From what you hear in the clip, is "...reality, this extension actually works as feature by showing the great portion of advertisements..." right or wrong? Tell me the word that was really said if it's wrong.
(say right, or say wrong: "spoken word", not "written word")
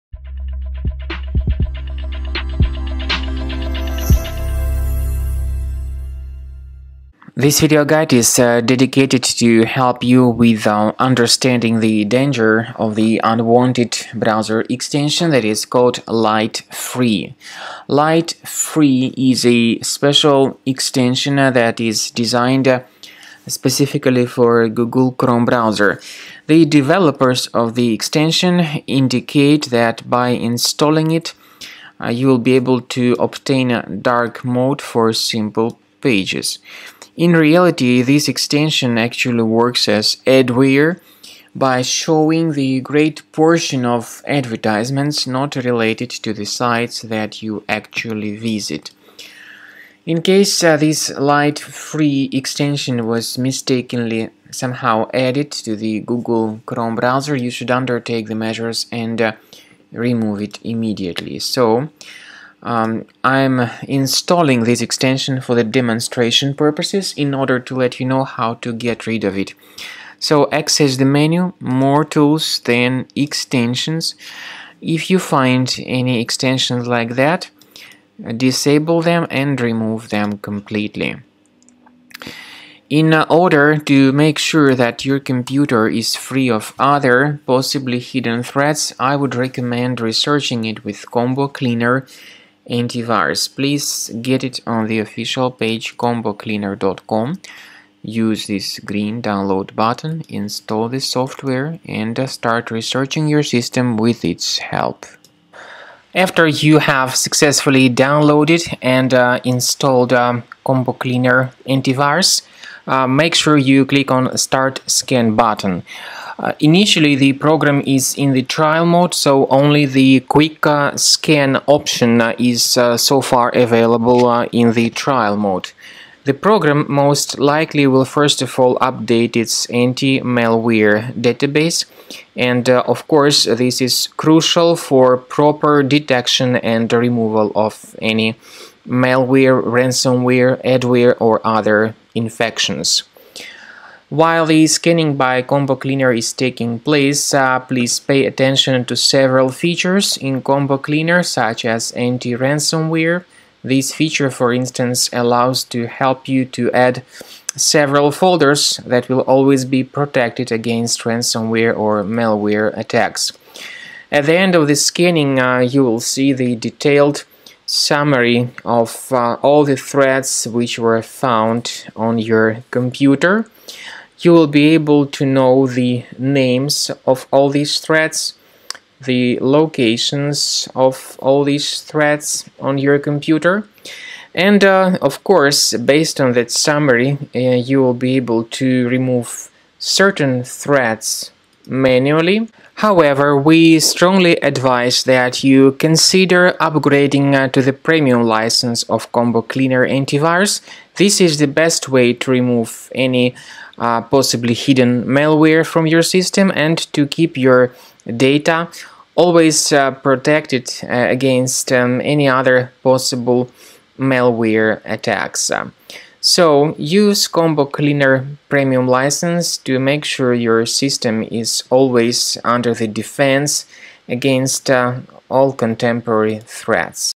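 wrong: "adware", not "feature".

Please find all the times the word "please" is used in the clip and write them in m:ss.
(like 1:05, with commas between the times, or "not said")
1:33, 2:27.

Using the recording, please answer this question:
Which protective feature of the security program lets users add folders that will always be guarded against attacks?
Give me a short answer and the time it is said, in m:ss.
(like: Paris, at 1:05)
Anti-ransomware, at 2:31.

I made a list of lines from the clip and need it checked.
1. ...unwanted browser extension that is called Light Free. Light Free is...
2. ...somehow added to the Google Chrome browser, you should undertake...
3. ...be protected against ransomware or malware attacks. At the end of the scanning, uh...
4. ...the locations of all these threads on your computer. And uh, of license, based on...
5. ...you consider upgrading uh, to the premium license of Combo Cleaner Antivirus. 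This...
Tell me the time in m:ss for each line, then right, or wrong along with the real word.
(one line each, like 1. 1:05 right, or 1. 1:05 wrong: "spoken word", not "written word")
1. 0:13 right
2. 0:54 right
3. 2:39 right
4. 2:59 wrong: "course", not "license"
5. 3:15 right.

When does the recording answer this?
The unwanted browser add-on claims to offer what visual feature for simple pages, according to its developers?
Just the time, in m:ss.
0:33.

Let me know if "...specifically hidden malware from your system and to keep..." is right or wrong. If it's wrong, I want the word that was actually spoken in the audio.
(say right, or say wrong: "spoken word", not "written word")
wrong: "possibly", not "specifically".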